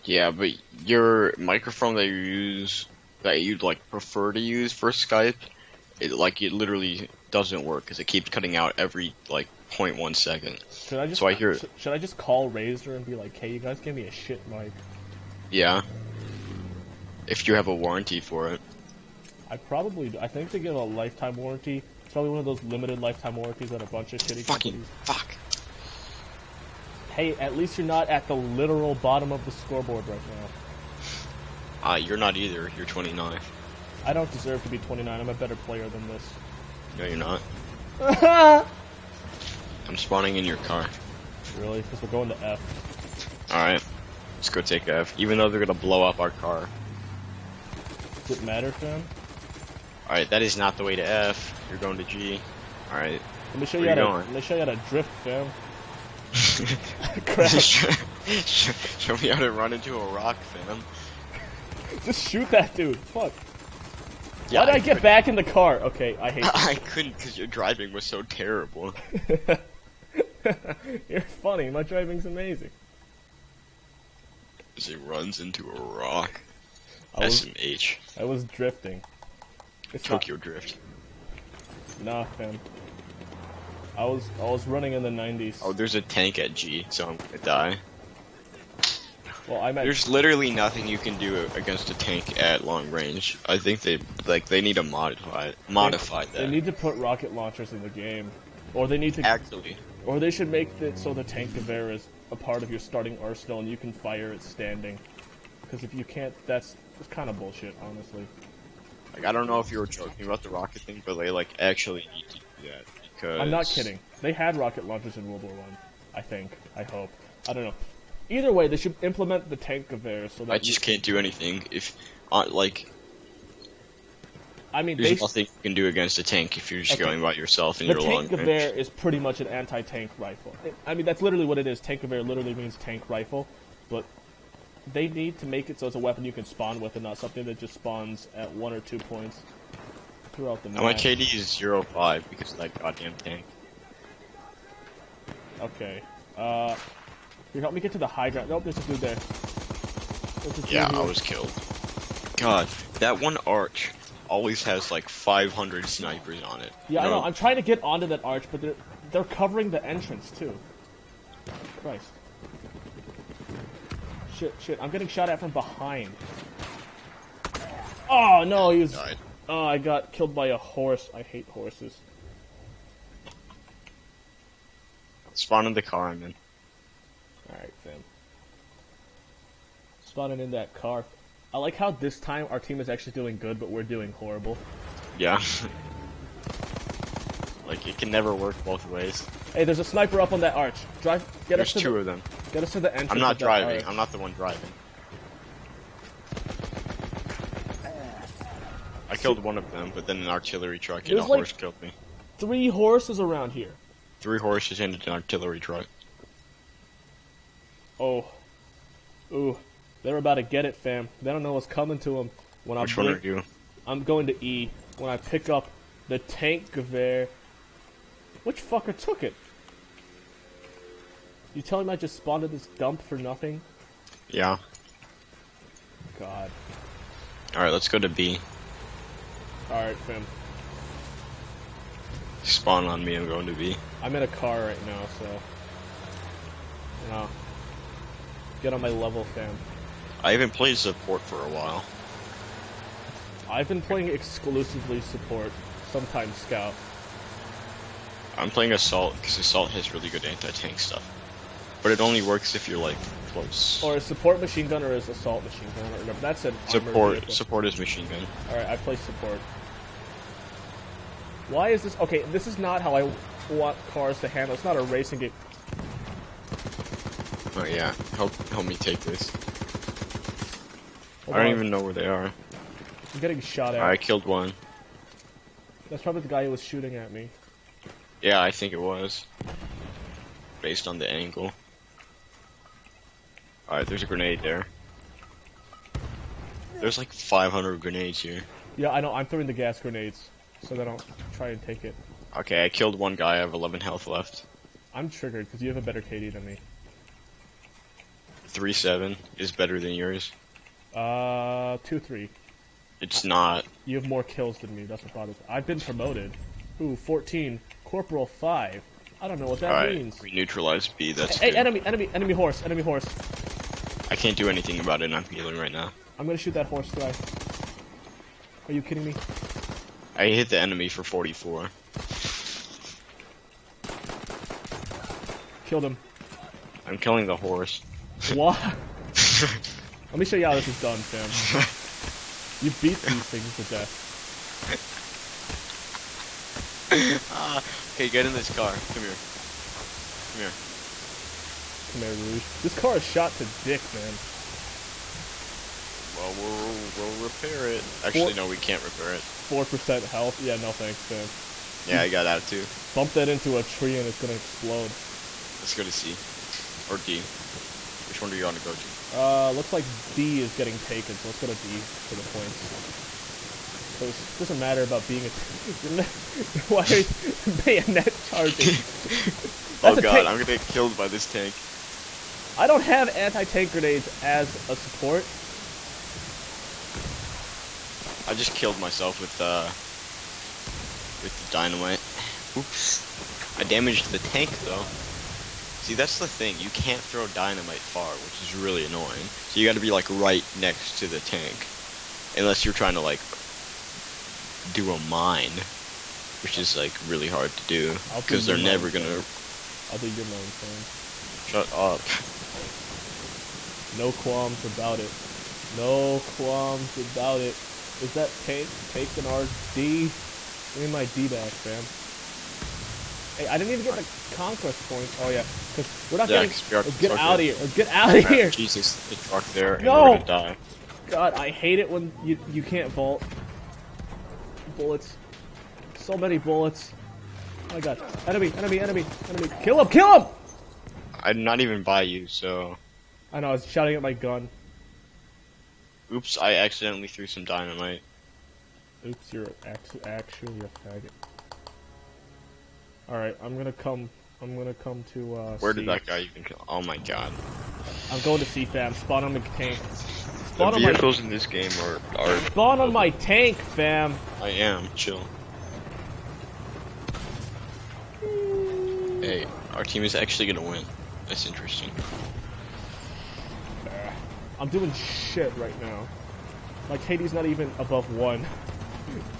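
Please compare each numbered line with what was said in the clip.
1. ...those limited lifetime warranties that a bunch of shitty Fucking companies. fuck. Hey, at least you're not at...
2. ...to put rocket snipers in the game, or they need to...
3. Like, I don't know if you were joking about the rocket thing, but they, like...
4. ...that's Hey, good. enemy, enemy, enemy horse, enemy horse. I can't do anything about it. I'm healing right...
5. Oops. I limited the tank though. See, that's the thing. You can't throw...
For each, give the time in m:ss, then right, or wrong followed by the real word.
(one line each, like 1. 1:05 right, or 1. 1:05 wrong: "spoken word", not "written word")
1. 0:22 right
2. 1:36 wrong: "launchers", not "snipers"
3. 1:49 right
4. 5:11 right
5. 6:22 wrong: "damaged", not "limited".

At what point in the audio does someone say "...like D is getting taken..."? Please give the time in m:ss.
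5:59.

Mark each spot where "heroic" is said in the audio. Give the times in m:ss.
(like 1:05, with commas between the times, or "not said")
not said.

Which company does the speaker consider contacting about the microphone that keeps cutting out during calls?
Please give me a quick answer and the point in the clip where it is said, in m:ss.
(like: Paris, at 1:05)
Razer, at 0:12.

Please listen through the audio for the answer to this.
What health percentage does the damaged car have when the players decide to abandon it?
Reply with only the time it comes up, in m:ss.
5:49.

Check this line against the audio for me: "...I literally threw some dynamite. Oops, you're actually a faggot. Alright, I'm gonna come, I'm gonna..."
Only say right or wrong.
wrong.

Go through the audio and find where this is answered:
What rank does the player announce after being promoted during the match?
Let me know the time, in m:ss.
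5:07.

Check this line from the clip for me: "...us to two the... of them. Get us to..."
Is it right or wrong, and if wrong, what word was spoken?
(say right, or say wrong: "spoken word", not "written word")
right.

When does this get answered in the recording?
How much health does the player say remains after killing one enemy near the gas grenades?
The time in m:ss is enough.
4:53.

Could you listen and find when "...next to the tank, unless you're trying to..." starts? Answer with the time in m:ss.
6:30.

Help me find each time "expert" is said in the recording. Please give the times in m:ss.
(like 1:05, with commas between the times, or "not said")
not said.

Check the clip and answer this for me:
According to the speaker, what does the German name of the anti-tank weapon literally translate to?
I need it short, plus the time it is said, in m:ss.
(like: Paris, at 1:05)
tank rifle, at 2:12.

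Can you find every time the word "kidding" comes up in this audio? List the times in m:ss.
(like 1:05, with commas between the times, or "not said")
1:53, 5:18.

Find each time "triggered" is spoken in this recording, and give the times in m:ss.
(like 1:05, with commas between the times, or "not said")
4:55.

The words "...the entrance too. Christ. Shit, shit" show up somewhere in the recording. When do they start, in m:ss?
2:39.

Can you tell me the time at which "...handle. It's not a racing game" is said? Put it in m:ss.
4:24.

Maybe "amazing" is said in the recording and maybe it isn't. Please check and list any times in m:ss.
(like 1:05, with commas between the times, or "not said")
1:12.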